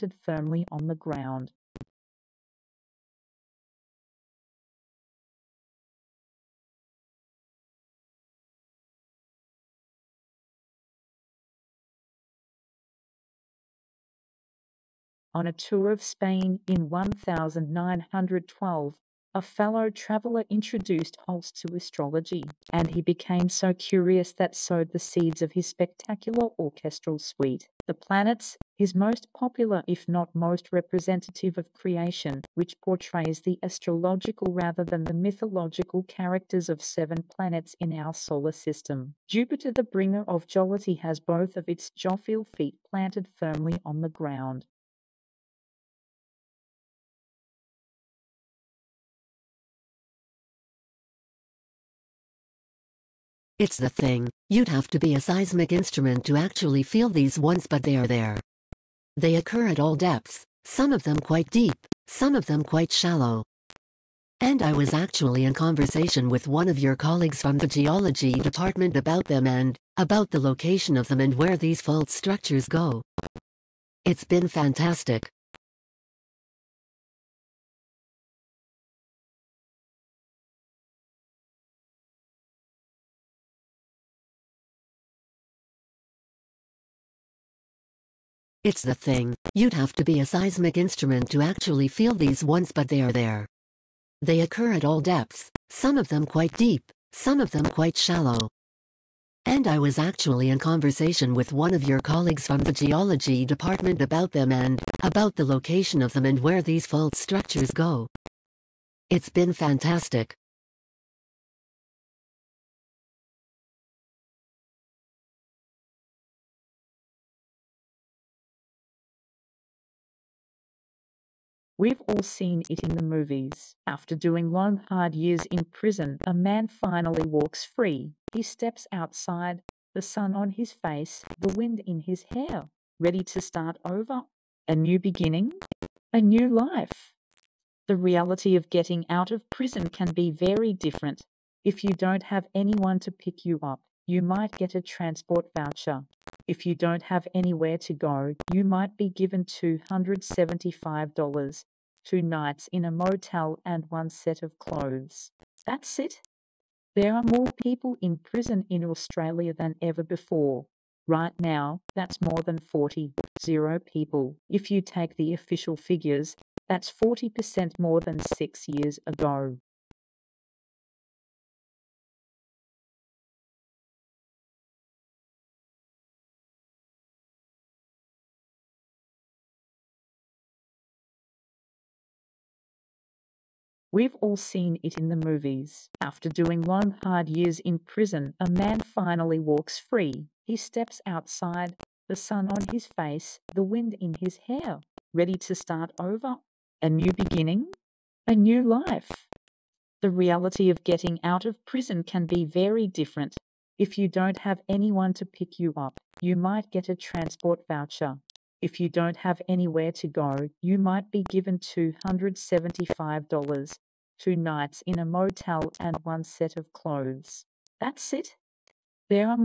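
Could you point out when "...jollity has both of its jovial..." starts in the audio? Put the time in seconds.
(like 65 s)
40 s.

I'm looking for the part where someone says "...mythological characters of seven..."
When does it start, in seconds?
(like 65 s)
35 s.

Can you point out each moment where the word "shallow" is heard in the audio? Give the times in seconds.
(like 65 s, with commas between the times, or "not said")
62 s, 97 s.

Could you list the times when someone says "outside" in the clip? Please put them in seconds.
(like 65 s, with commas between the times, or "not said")
128 s, 191 s.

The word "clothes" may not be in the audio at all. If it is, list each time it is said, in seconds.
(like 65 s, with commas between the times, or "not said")
154 s, 216 s.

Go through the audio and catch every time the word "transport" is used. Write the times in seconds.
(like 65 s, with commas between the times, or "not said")
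144 s, 206 s.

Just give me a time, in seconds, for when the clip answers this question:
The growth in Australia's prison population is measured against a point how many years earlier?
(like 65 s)
168 s.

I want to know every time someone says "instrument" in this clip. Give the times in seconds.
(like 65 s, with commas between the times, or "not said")
55 s, 90 s.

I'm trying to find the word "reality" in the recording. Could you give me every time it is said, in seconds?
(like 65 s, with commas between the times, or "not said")
137 s, 200 s.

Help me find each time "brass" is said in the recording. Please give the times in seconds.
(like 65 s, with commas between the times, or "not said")
not said.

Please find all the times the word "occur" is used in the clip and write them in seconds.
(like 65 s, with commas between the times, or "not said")
59 s, 94 s.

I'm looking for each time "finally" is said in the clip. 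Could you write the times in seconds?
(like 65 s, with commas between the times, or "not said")
126 s, 188 s.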